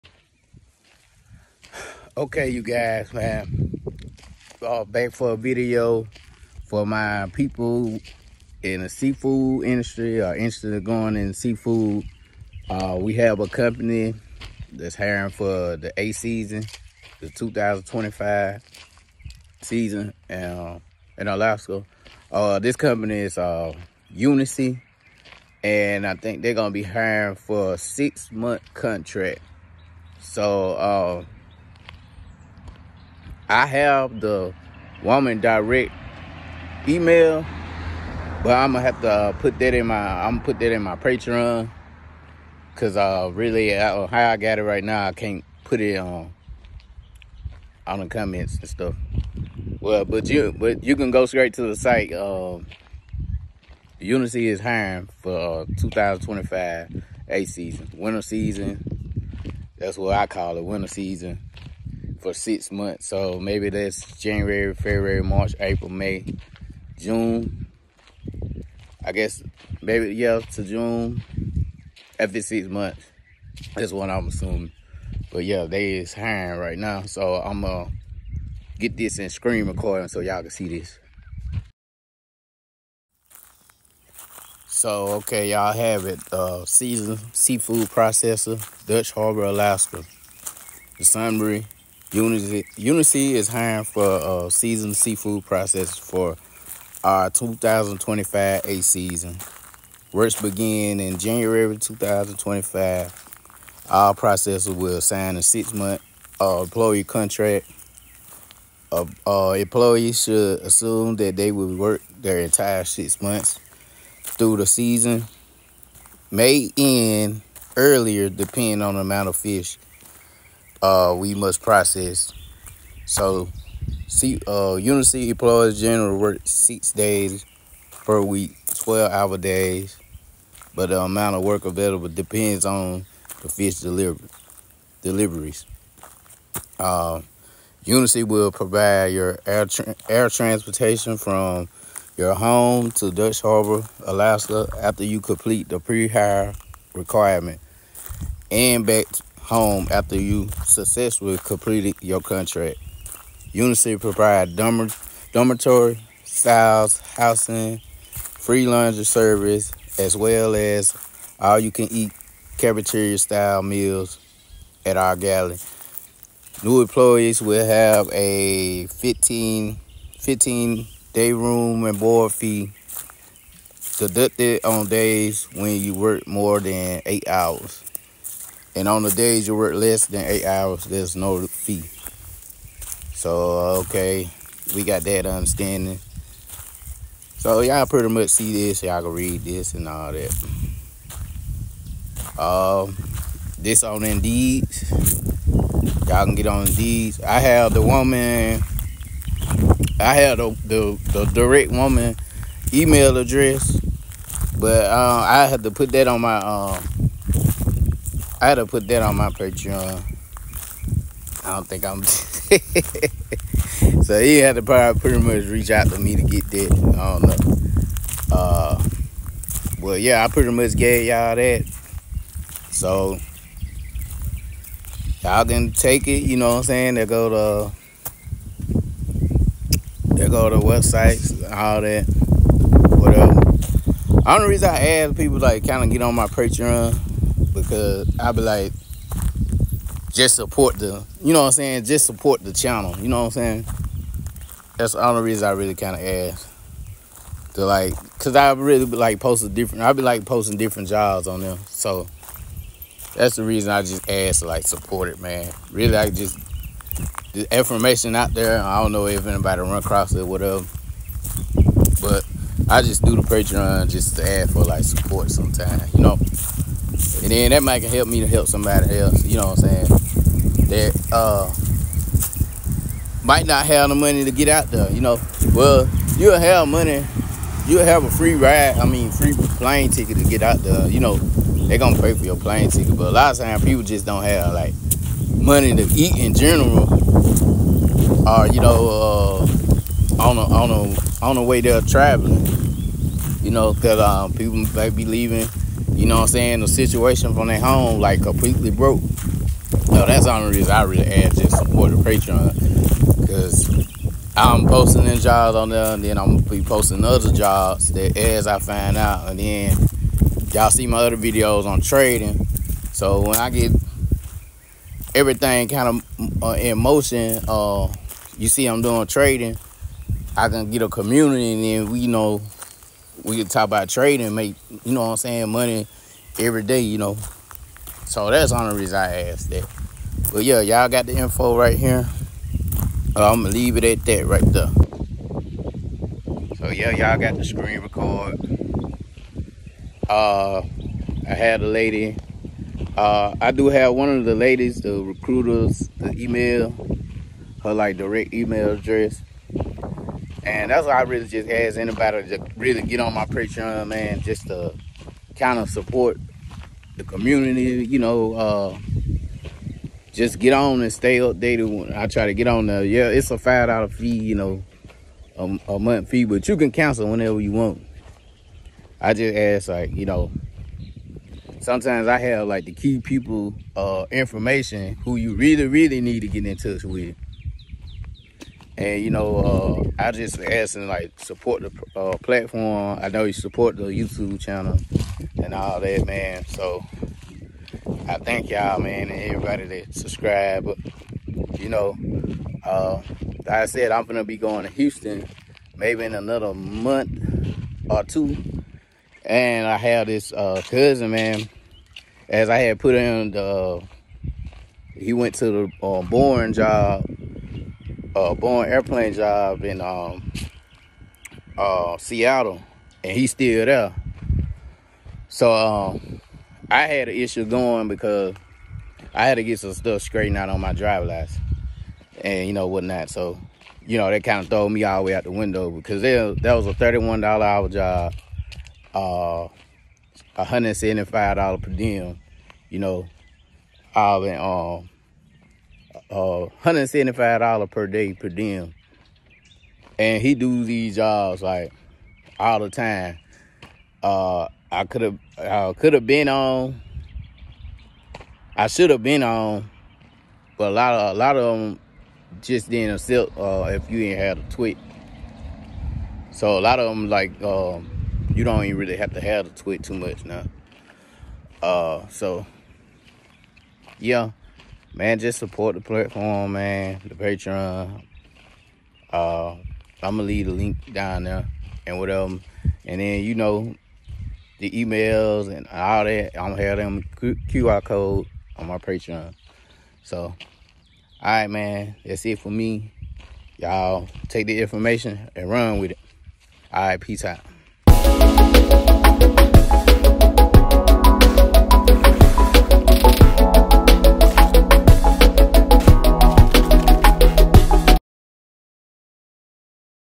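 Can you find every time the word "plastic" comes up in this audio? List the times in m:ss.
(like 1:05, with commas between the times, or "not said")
not said.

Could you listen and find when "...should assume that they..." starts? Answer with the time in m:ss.
1:50.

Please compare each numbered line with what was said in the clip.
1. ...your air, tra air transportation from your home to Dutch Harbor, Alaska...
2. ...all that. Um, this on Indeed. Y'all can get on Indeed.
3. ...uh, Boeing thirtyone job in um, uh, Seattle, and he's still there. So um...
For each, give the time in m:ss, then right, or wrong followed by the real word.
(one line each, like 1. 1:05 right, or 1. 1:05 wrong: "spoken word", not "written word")
1. 2:19 right
2. 3:09 right
3. 6:48 wrong: "airplane", not "thirtyone".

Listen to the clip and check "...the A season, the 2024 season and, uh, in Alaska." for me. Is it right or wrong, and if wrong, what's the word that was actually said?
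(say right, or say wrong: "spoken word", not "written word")
wrong: "2025", not "2024".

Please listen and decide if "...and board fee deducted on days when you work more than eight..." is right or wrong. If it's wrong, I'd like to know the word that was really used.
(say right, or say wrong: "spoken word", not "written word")
right.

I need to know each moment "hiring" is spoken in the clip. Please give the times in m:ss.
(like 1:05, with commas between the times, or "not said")
0:14, 0:26, 0:54, 1:16, 1:33.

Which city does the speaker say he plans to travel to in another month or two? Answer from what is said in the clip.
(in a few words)
Houston.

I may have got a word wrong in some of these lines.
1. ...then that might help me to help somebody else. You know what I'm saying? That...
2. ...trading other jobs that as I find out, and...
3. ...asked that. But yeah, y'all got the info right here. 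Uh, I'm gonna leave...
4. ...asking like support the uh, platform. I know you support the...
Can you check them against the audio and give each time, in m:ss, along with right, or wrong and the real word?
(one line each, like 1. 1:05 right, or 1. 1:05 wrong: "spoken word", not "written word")
1. 4:27 right
2. 5:06 wrong: "posting", not "trading"
3. 5:29 right
4. 6:20 right.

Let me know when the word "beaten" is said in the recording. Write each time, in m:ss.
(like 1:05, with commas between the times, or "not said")
not said.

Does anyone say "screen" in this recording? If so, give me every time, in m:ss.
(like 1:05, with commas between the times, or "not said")
1:19, 5:37.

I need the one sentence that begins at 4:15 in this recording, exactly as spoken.
Really, I just, the information out there, I don't know if anybody run across it, whatever.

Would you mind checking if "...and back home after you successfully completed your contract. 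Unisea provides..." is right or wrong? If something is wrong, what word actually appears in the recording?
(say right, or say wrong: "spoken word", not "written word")
right.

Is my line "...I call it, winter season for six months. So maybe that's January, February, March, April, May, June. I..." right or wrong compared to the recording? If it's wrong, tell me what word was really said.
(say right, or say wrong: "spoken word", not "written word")
right.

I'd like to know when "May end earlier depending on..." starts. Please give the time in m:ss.
1:56.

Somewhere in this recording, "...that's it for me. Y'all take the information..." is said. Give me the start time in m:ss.
8:02.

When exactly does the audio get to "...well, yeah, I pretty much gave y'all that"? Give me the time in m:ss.
3:39.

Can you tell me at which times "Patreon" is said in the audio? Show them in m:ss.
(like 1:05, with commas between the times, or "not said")
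0:40, 3:29, 3:56, 4:23, 5:01, 5:53, 7:47, 7:58.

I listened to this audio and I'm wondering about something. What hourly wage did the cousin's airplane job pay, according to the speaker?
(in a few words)
$31.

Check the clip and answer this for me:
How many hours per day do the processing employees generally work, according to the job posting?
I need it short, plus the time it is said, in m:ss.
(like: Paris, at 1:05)
12, at 2:08.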